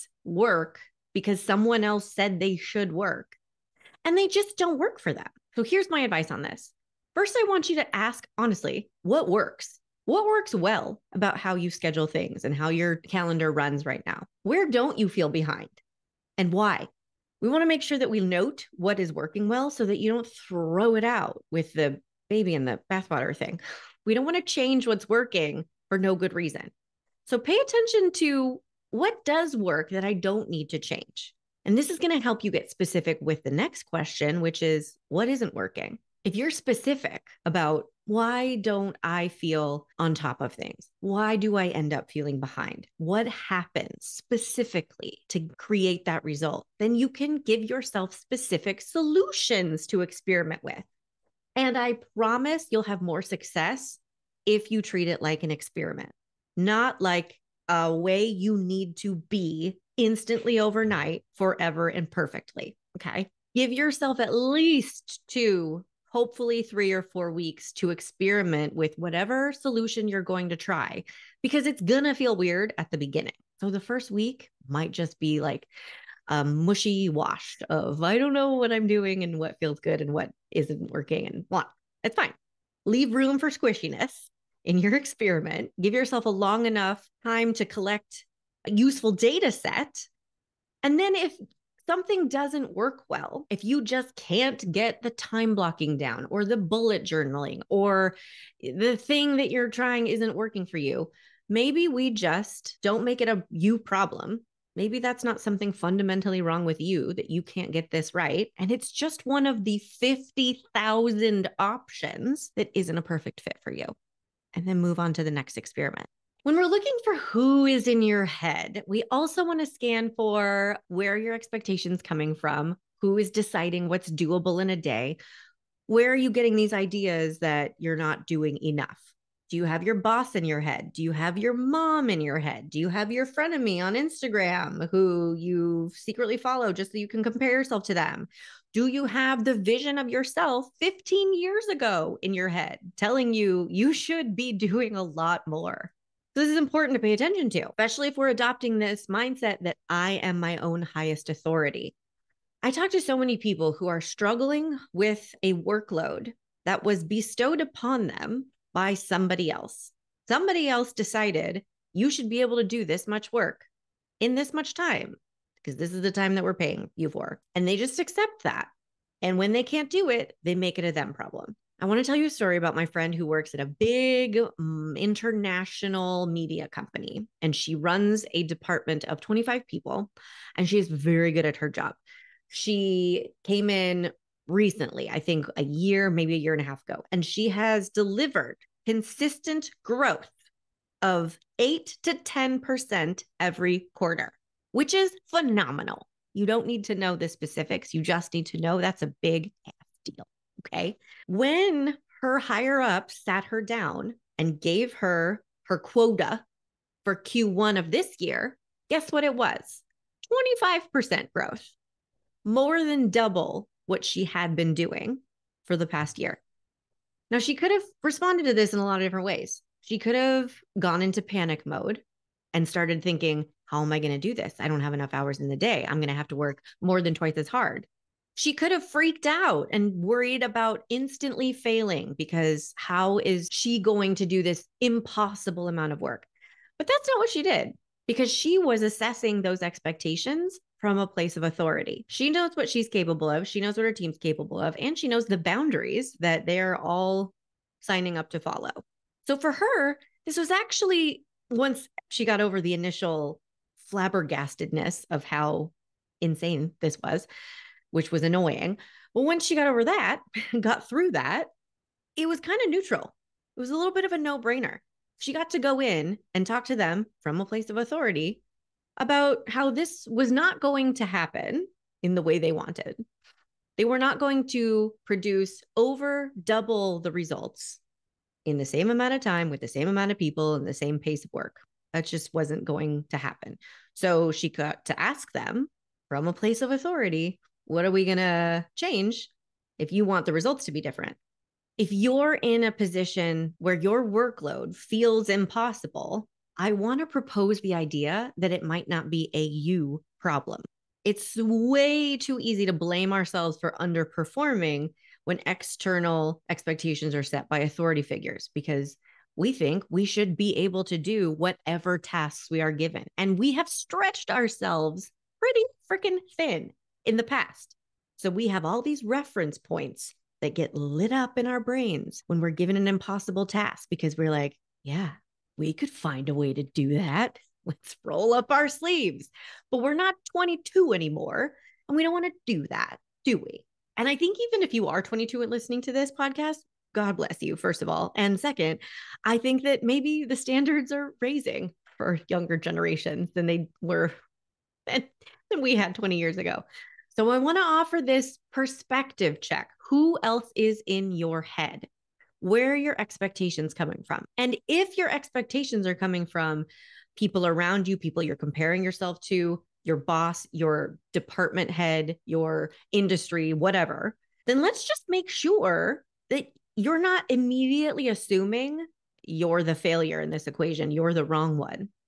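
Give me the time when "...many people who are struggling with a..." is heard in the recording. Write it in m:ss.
2:33.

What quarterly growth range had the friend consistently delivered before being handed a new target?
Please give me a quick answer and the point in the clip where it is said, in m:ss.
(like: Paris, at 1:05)
8 to 10%, at 3:11.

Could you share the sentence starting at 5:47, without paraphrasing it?
So I want to offer this perspective check.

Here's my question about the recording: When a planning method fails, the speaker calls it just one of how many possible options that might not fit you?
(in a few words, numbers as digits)
50,000.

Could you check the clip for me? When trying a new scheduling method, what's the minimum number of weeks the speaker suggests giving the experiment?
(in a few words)
2.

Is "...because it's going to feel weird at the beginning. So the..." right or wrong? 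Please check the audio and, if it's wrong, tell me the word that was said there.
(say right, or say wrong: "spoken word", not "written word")
right.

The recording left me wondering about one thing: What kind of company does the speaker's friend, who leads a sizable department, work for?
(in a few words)
International media company.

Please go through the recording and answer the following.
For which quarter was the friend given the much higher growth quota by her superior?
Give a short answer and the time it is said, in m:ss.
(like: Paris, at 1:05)
Q1, at 3:27.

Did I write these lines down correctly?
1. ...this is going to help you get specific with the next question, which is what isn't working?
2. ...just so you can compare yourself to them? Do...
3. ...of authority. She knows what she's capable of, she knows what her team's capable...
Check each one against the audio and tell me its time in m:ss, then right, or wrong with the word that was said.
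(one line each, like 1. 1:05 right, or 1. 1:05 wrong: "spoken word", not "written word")
1. 0:31 right
2. 2:16 right
3. 4:01 right.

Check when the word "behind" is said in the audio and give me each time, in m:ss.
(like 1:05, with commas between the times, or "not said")
0:15, 0:42.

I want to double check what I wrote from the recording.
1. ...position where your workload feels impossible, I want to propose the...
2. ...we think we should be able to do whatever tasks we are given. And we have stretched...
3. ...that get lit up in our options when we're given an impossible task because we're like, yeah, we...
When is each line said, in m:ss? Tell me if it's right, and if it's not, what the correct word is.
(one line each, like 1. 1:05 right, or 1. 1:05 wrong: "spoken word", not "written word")
1. 4:52 right
2. 5:09 right
3. 5:20 wrong: "brains", not "options".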